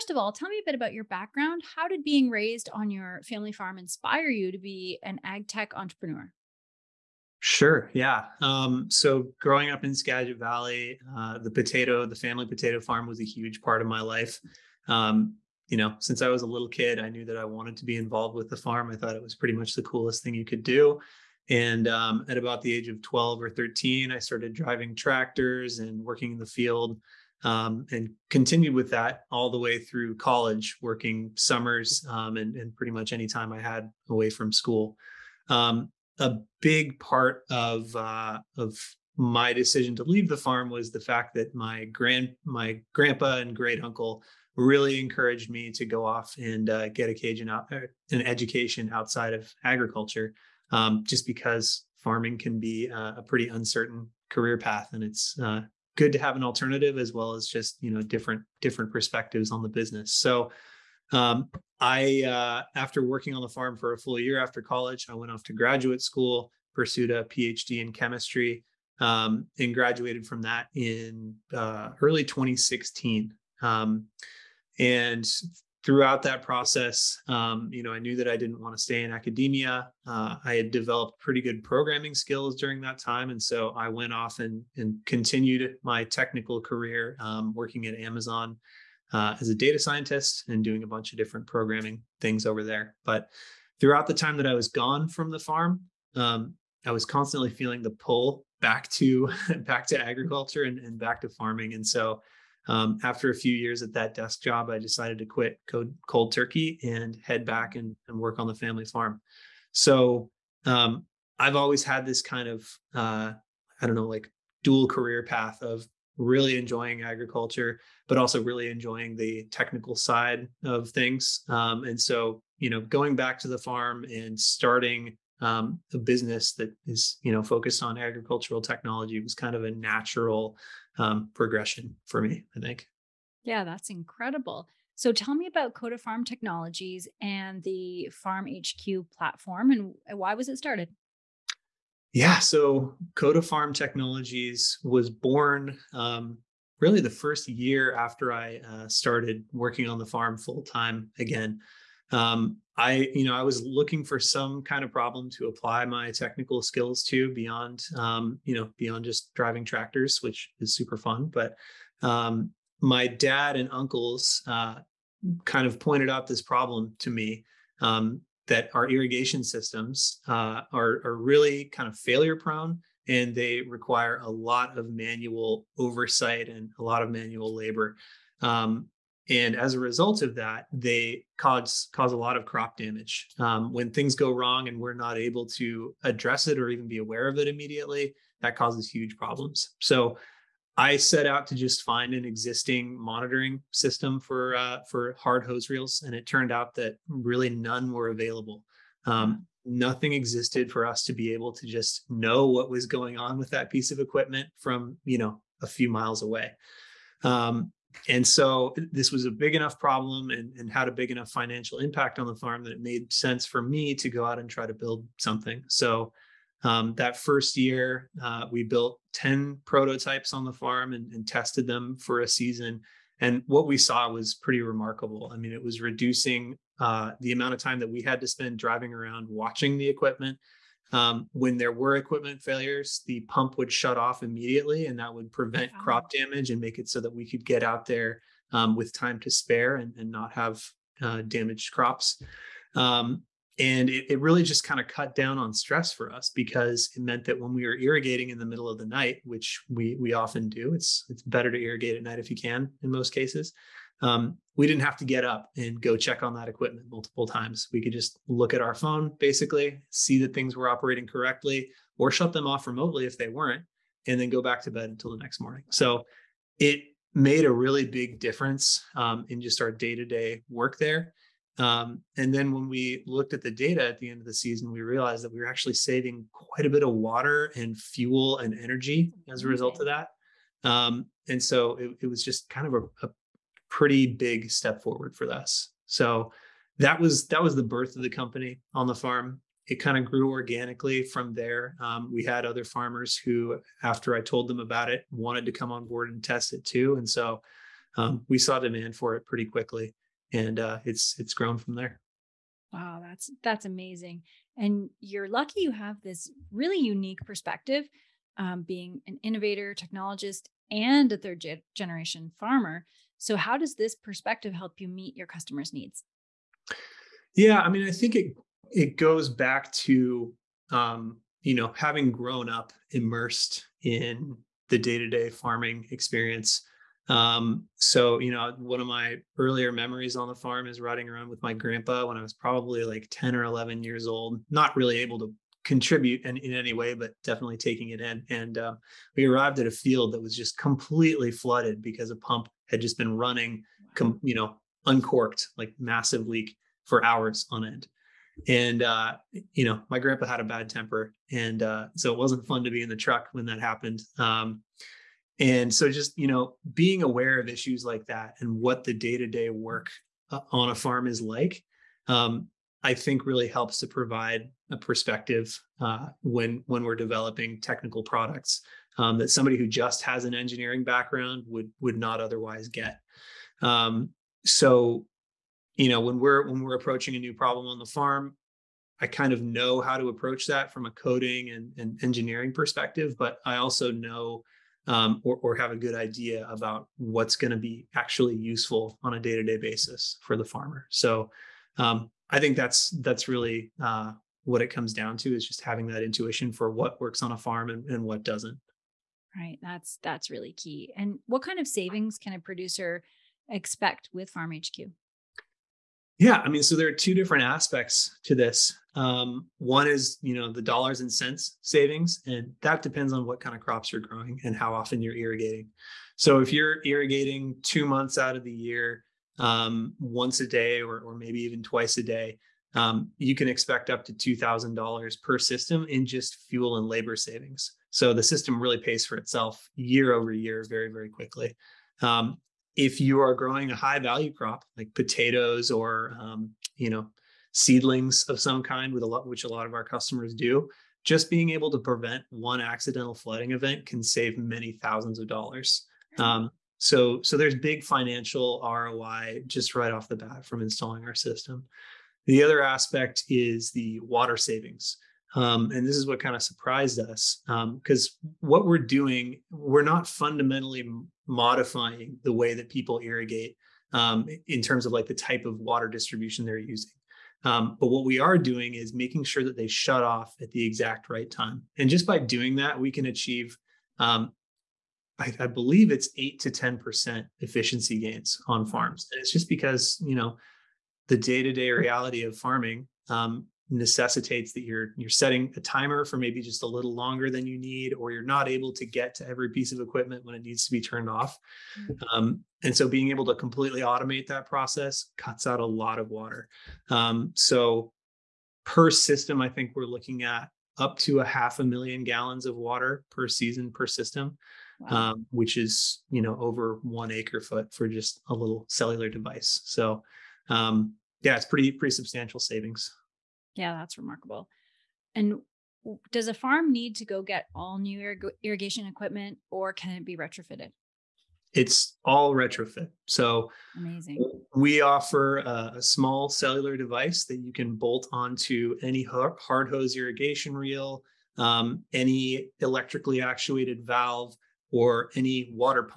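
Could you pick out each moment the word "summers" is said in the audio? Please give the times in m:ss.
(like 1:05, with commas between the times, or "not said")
0:31.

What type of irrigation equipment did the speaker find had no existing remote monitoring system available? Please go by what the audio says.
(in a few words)
Hard hose reels.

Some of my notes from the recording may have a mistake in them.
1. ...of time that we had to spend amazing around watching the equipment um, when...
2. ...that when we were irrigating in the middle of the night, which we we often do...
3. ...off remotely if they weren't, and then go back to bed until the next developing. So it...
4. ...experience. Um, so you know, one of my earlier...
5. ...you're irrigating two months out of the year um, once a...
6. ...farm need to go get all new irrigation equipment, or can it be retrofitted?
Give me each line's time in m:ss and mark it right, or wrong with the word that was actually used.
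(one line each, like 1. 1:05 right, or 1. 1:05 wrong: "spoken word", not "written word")
1. 3:47 wrong: "driving", not "amazing"
2. 4:07 right
3. 4:22 wrong: "morning", not "developing"
4. 5:25 right
5. 6:56 right
6. 8:36 right.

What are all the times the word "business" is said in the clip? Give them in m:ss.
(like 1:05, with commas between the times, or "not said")
0:59, 2:05.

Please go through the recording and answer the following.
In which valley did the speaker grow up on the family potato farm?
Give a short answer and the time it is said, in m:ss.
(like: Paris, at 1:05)
Skagit Valley, at 0:09.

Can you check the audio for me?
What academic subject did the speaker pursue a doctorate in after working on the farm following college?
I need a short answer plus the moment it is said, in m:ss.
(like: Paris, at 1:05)
Chemistry, at 1:07.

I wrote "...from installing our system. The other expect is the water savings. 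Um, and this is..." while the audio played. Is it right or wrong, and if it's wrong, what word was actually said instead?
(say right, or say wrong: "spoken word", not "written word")
wrong: "aspect", not "expect".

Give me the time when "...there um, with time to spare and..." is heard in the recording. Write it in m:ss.
3:57.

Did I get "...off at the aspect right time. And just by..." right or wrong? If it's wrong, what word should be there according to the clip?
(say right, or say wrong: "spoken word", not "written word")
wrong: "exact", not "aspect".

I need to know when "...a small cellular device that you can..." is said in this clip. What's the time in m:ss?
8:45.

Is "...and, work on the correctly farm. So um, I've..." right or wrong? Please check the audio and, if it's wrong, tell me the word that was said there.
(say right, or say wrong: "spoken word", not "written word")
wrong: "family", not "correctly".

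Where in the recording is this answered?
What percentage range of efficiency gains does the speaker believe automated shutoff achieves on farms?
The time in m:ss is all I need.
7:56.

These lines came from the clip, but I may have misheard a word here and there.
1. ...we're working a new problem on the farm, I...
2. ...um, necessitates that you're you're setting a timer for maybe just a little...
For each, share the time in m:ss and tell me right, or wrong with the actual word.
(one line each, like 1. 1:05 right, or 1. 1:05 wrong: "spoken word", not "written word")
1. 6:16 wrong: "approaching", not "working"
2. 8:03 right.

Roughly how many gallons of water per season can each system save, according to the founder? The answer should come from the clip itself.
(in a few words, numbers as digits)
Half a million.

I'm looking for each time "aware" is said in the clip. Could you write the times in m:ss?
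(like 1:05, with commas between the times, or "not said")
3:06, 5:57.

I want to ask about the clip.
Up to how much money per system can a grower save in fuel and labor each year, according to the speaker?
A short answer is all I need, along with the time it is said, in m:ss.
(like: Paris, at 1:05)
$2,000, at 7:04.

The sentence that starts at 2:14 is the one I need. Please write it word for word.
So tell me about Coda Farm Technologies and the FarmHQ platform and why was it started?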